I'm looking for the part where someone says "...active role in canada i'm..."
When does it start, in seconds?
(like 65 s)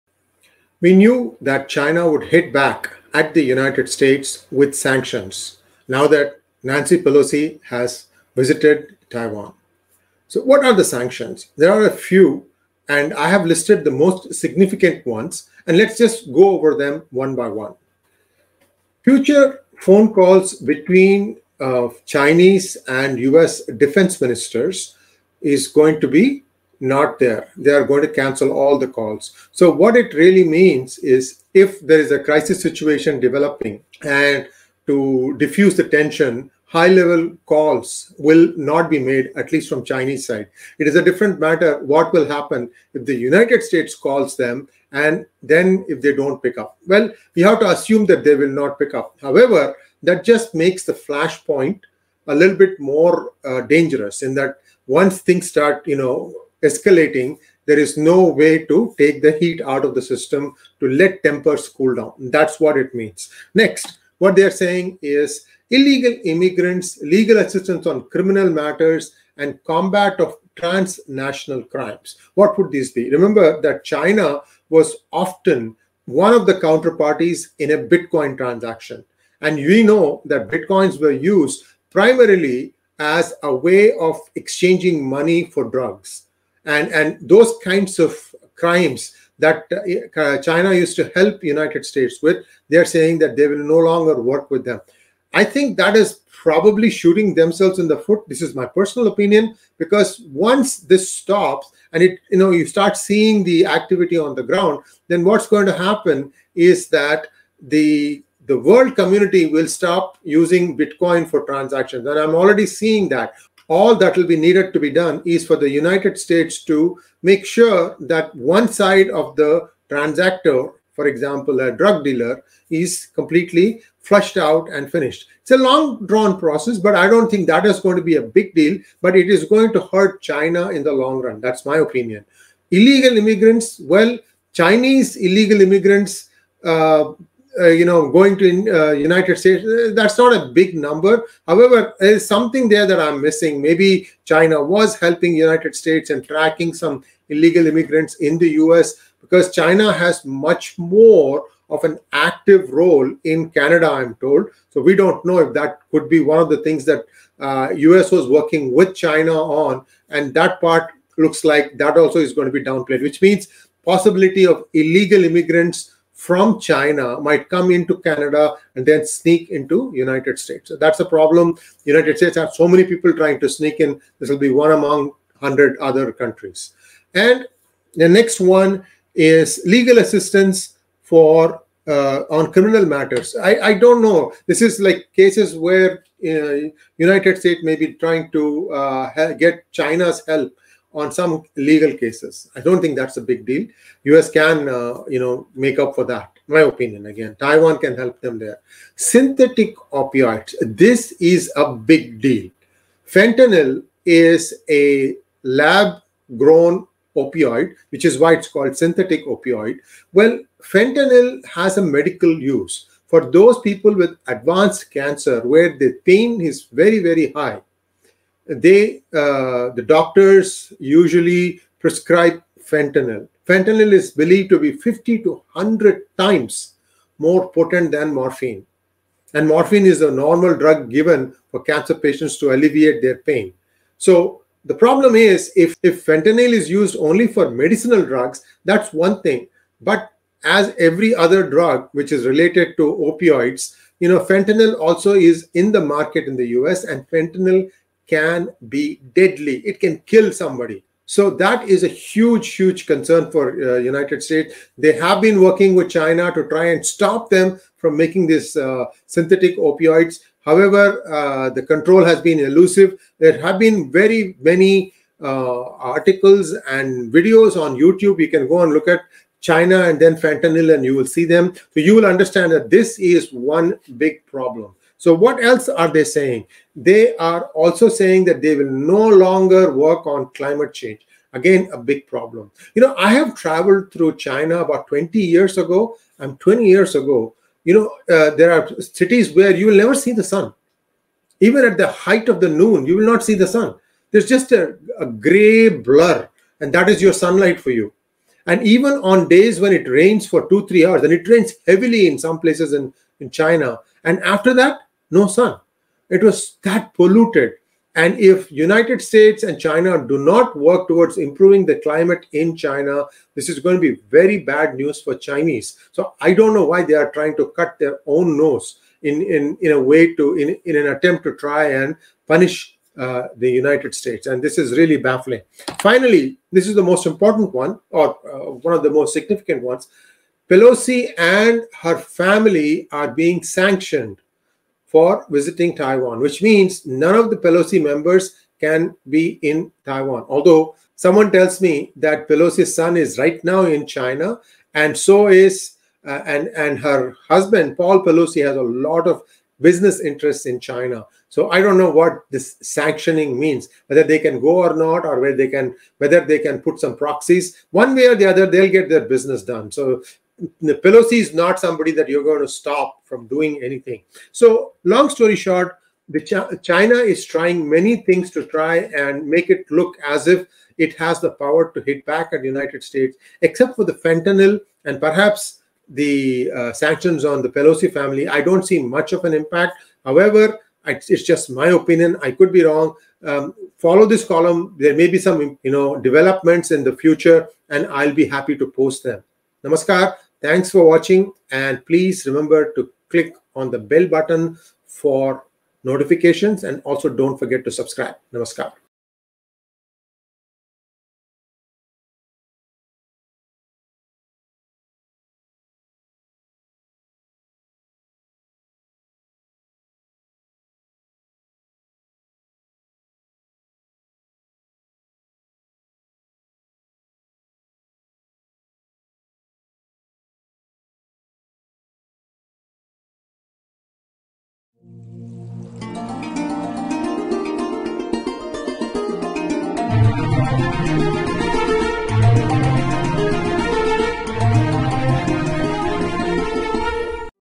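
152 s.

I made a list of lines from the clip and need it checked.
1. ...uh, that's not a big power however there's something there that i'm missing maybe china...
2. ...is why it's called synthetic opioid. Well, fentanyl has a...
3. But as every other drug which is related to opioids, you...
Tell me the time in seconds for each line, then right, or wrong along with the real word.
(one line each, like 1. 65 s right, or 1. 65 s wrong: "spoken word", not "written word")
1. 139 s wrong: "number", not "power"
2. 208 s right
3. 239 s right.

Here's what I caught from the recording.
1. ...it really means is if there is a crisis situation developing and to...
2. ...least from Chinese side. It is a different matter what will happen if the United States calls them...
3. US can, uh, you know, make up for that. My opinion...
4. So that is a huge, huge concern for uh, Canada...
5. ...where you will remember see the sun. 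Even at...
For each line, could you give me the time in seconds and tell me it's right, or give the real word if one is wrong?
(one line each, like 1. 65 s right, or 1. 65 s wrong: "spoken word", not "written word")
1. 29 s right
2. 39 s right
3. 194 s right
4. 251 s wrong: "United", not "Canada"
5. 289 s wrong: "never", not "remember".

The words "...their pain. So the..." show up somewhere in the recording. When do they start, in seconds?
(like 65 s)
233 s.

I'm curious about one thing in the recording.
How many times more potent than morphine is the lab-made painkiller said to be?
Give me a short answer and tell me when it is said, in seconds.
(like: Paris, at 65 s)
50 to 100, at 224 s.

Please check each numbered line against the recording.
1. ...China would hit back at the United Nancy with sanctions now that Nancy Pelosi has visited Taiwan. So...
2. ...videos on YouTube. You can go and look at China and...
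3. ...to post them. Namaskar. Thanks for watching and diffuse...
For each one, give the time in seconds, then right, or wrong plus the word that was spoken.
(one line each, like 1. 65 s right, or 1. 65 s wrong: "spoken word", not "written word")
1. 1 s wrong: "States", not "Nancy"
2. 267 s right
3. 388 s wrong: "please", not "diffuse".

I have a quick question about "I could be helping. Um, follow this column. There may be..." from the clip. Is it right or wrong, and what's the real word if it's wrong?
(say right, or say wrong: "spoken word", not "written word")
wrong: "wrong", not "helping".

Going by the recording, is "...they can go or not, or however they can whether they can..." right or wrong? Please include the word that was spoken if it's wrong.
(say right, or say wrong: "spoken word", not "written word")
wrong: "whether", not "however".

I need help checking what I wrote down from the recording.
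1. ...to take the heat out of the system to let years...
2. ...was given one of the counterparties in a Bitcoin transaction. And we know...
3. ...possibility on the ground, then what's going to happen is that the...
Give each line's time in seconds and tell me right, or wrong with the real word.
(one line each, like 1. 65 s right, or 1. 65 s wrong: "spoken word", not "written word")
1. 58 s wrong: "tempers", not "years"
2. 74 s wrong: "often", not "given"
3. 103 s wrong: "activity", not "possibility".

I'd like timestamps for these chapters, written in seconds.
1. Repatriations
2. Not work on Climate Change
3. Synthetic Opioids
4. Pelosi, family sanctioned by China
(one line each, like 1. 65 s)
1. 65 s
2. 280 s
3. 188 s
4. 331 s.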